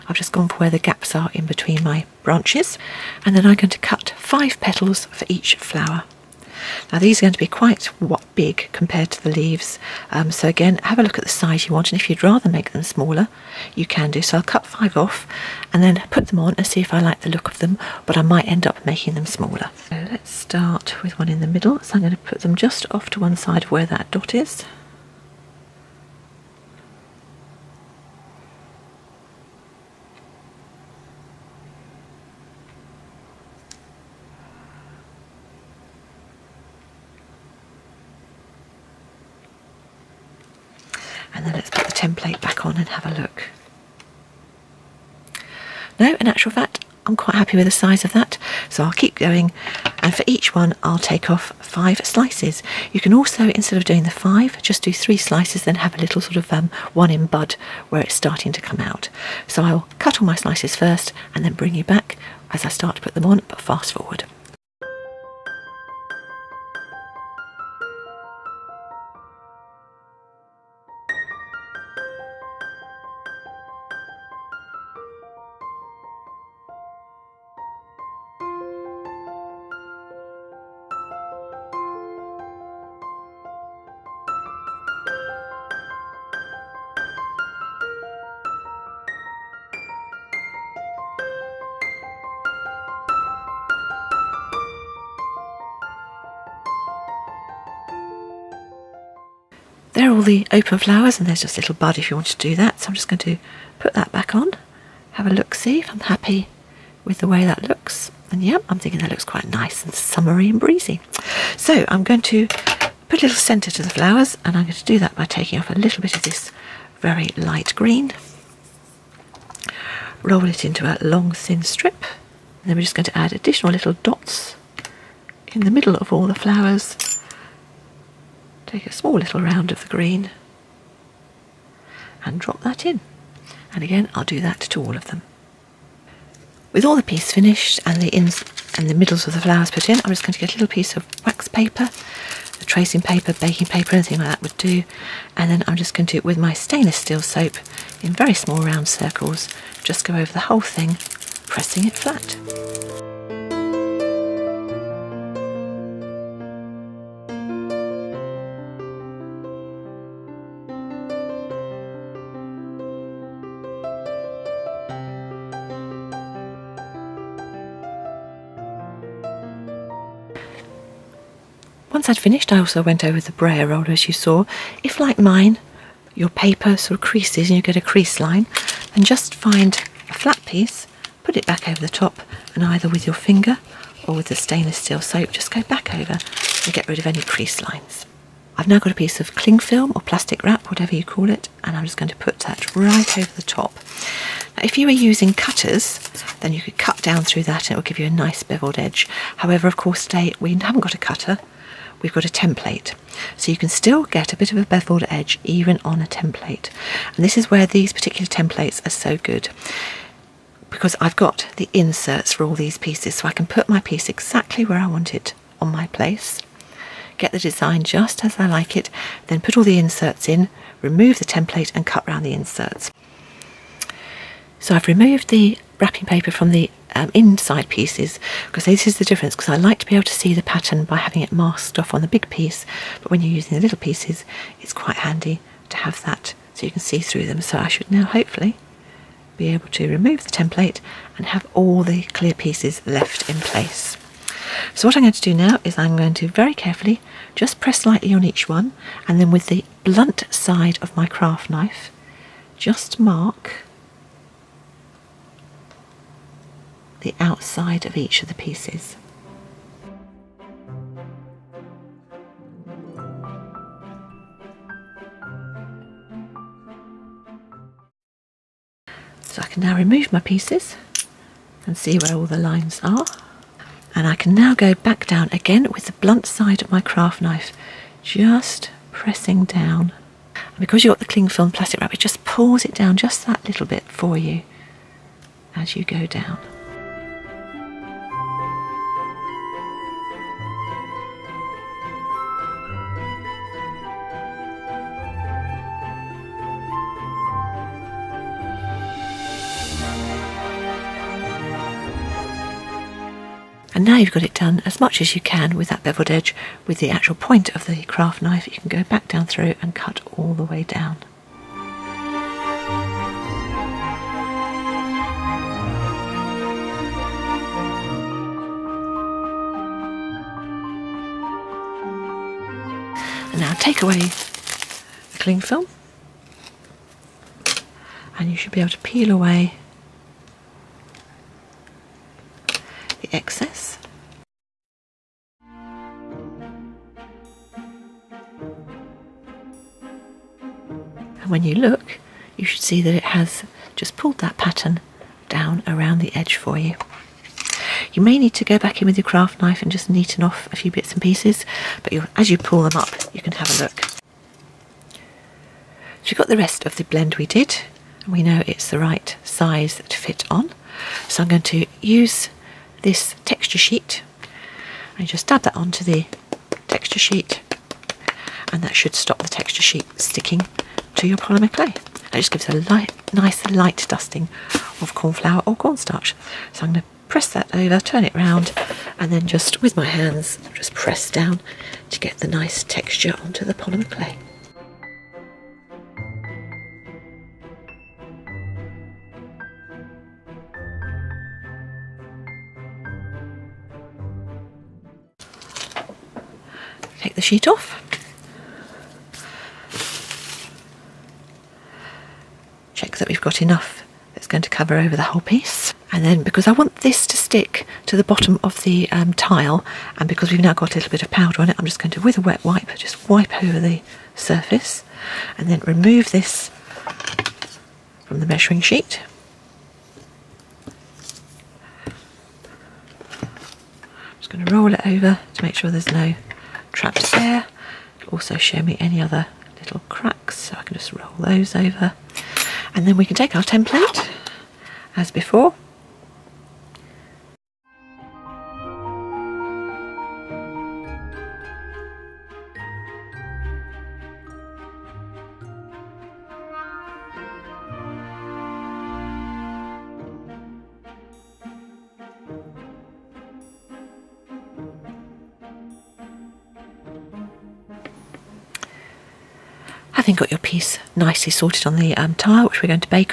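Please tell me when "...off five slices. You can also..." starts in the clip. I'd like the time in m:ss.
0:51.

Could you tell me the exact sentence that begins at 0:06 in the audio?
Now these are going to be quite what big compared to the leaves.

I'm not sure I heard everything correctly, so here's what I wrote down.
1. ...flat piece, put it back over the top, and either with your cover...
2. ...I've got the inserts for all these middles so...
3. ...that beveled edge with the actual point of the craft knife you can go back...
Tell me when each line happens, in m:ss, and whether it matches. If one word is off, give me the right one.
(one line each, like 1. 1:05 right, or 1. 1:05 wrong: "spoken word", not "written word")
1. 3:00 wrong: "finger", not "cover"
2. 3:31 wrong: "pieces", not "middles"
3. 5:05 right.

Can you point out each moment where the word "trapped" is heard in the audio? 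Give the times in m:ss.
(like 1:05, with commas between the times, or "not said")
7:06.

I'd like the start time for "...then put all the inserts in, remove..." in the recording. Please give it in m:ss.
3:39.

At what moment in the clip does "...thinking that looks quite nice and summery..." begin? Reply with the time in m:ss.
1:48.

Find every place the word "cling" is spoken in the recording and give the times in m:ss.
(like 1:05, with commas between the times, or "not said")
3:09, 4:41, 5:25.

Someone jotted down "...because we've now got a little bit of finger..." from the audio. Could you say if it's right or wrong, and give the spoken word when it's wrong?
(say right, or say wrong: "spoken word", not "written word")
wrong: "powder", not "finger".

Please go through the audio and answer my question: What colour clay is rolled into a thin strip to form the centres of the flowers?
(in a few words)
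very light green.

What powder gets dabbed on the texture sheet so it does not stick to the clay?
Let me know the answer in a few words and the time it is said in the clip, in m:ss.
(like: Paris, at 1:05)
corn flour, at 6:14.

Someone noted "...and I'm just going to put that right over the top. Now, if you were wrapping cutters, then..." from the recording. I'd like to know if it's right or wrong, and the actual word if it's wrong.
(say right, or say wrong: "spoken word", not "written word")
wrong: "using", not "wrapping".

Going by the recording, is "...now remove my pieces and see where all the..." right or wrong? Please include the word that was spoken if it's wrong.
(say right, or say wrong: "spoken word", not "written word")
right.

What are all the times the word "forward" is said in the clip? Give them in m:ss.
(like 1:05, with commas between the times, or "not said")
1:03.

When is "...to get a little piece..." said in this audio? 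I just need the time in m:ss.
2:20.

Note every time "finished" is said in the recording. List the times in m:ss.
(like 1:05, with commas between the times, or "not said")
2:17, 2:52.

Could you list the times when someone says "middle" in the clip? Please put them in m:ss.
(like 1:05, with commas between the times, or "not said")
0:21, 2:05, 2:18.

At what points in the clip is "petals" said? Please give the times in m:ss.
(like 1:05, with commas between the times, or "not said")
0:04.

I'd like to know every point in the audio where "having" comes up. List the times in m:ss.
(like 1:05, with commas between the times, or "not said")
3:50, 7:40.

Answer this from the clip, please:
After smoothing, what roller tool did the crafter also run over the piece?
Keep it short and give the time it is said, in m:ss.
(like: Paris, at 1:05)
brayer roller, at 2:53.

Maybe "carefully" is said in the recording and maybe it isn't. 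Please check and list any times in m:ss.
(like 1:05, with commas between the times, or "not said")
4:06.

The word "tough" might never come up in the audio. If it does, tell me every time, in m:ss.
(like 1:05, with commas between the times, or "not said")
not said.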